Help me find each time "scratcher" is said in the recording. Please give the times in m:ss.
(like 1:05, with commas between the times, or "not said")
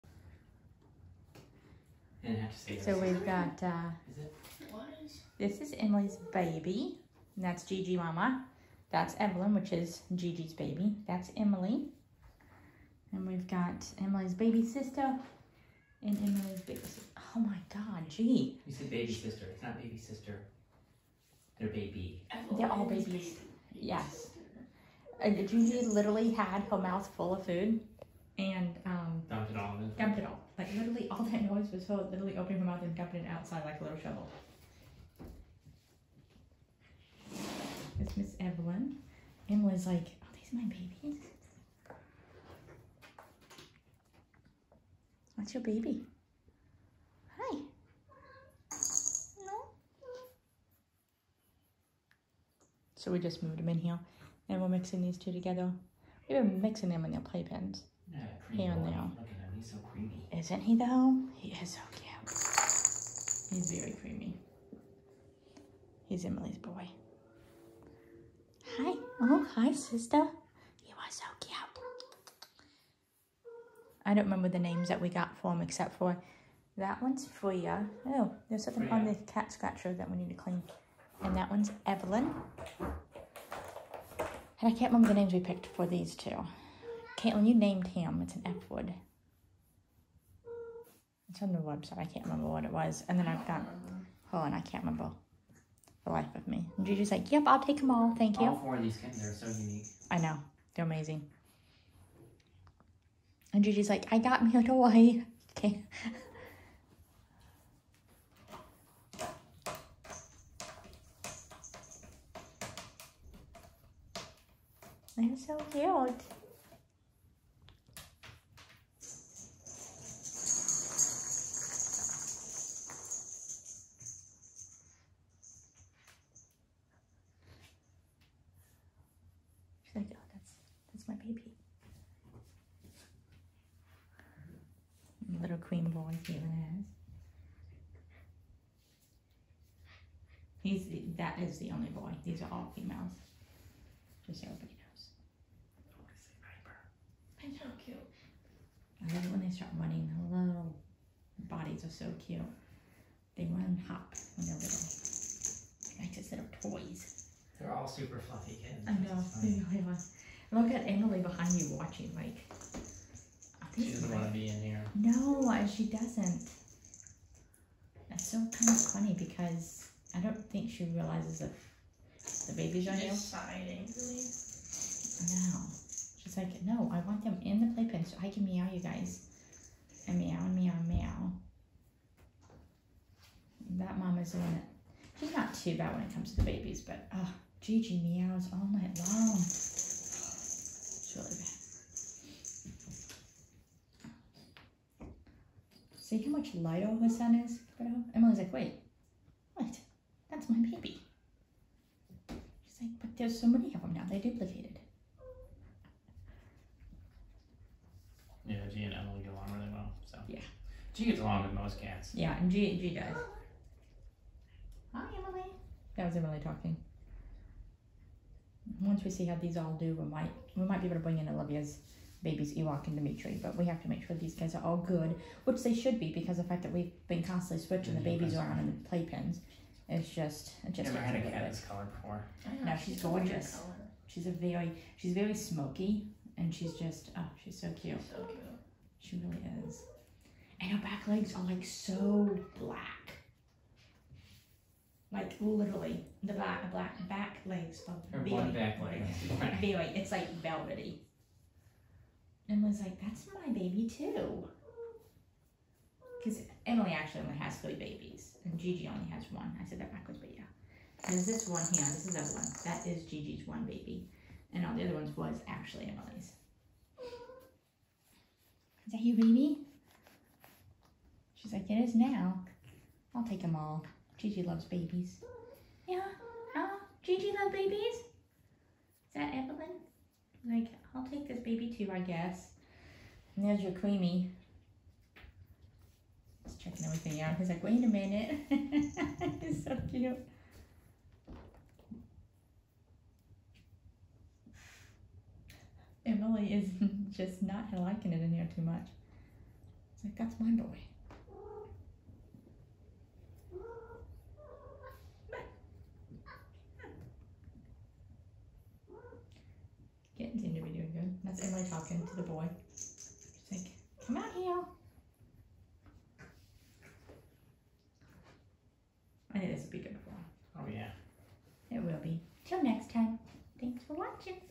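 1:19.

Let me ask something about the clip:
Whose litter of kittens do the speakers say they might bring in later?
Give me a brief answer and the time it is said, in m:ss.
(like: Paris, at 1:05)
Olivia, at 3:41.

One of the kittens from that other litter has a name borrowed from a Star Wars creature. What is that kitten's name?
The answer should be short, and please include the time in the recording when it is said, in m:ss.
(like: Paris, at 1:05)
Ewok, at 3:42.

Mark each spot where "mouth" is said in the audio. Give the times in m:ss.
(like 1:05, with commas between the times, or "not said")
0:26, 0:32.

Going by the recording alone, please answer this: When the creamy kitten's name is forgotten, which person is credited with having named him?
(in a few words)
Caitlin.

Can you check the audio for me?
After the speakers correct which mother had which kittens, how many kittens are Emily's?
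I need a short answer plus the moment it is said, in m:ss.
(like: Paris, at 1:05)
3, at 4:17.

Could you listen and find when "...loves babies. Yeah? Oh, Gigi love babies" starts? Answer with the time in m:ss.
4:34.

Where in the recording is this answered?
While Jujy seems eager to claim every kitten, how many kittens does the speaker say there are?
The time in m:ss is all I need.
1:38.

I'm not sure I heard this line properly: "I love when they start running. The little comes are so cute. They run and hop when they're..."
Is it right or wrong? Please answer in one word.
wrong.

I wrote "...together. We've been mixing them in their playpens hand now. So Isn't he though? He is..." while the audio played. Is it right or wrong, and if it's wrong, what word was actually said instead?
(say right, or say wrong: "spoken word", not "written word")
right.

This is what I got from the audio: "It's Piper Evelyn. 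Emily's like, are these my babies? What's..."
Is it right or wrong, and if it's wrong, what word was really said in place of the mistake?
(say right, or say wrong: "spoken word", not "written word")
wrong: "Miss", not "Piper".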